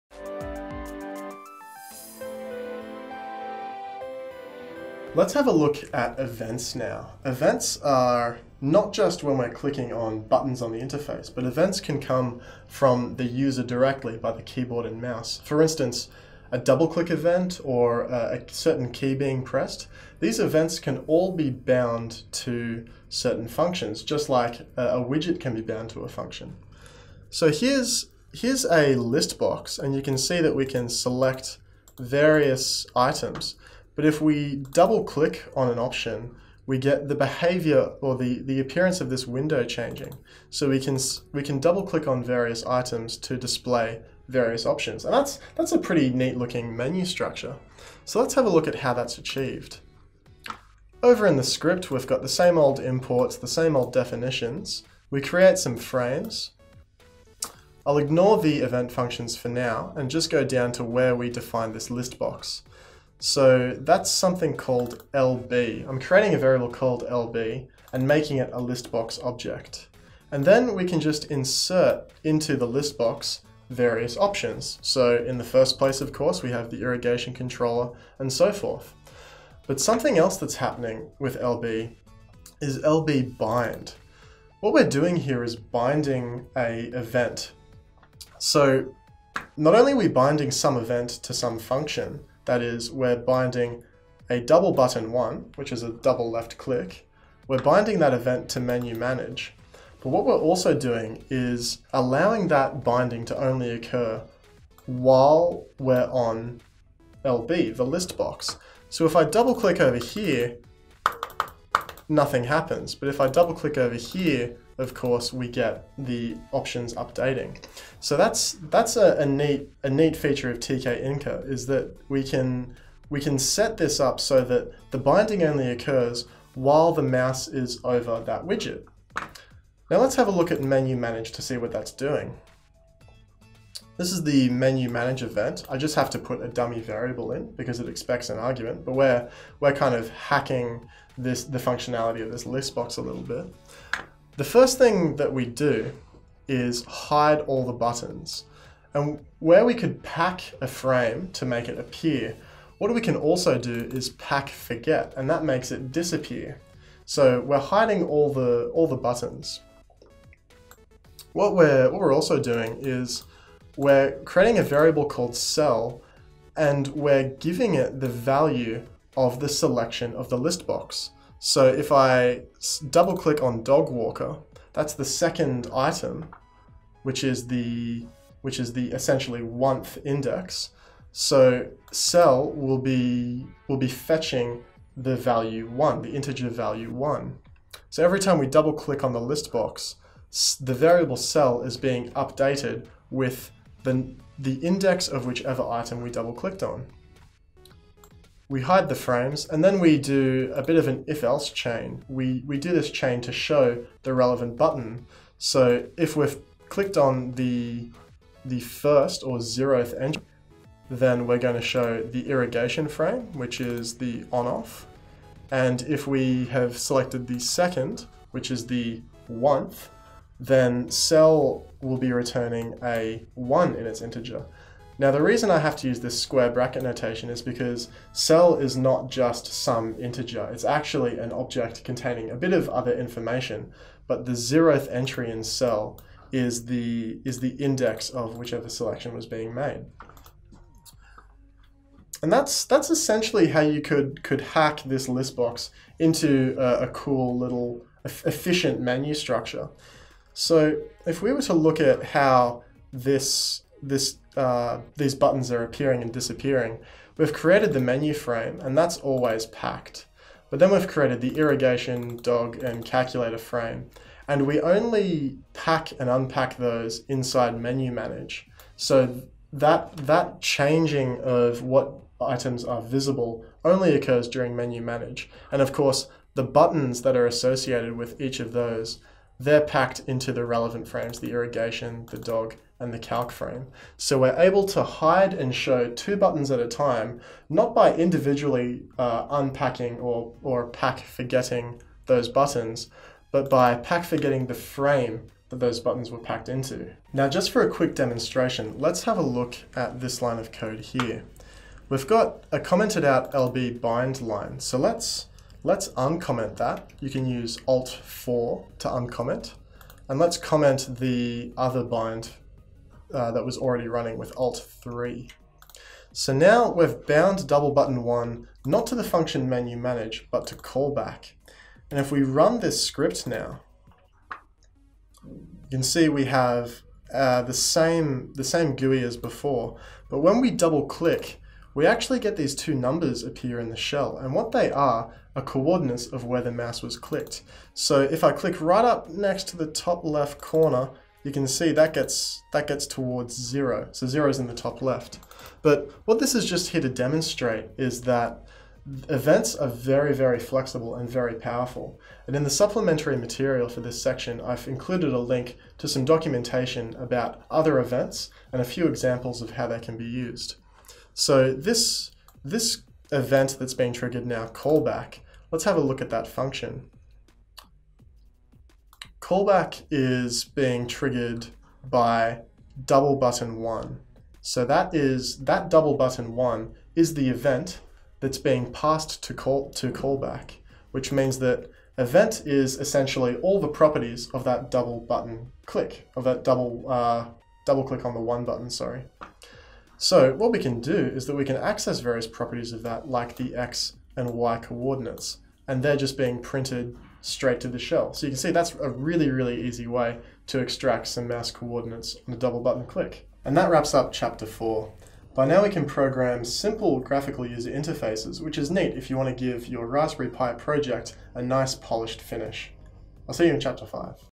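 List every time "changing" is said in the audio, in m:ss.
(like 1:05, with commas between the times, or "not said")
0:39, 4:30.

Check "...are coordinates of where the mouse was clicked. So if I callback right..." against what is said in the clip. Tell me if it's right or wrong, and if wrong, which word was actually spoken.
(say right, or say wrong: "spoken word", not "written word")
wrong: "click", not "callback".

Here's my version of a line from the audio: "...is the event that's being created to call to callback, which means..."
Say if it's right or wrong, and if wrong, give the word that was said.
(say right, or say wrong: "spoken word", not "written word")
wrong: "passed", not "created".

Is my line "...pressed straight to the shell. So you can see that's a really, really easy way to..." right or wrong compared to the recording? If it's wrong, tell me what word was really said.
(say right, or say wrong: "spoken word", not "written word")
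wrong: "printed", not "pressed".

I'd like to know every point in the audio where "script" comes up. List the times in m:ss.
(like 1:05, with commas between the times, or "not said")
0:51, 5:22.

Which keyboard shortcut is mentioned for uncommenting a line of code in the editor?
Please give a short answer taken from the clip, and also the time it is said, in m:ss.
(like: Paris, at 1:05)
Alt 4, at 5:07.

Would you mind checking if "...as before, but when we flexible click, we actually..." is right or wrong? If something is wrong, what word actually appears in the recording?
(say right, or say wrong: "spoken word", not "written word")
wrong: "double", not "flexible".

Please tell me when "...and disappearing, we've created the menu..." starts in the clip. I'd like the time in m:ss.
4:16.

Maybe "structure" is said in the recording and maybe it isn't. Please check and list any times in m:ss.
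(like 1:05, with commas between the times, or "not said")
0:47, 4:09.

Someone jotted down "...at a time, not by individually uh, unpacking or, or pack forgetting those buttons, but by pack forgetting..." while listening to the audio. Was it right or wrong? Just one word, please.
right.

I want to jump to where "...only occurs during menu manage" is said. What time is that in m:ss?
4:33.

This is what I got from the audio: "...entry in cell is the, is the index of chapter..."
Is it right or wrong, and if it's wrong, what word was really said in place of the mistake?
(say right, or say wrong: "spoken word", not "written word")
wrong: "whichever", not "chapter".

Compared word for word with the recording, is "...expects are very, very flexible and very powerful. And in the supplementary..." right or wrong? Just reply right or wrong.
wrong.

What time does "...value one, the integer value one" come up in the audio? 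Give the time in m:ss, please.
3:05.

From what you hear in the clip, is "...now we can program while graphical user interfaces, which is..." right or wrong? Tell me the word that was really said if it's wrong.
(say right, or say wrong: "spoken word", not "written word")
wrong: "simple", not "while".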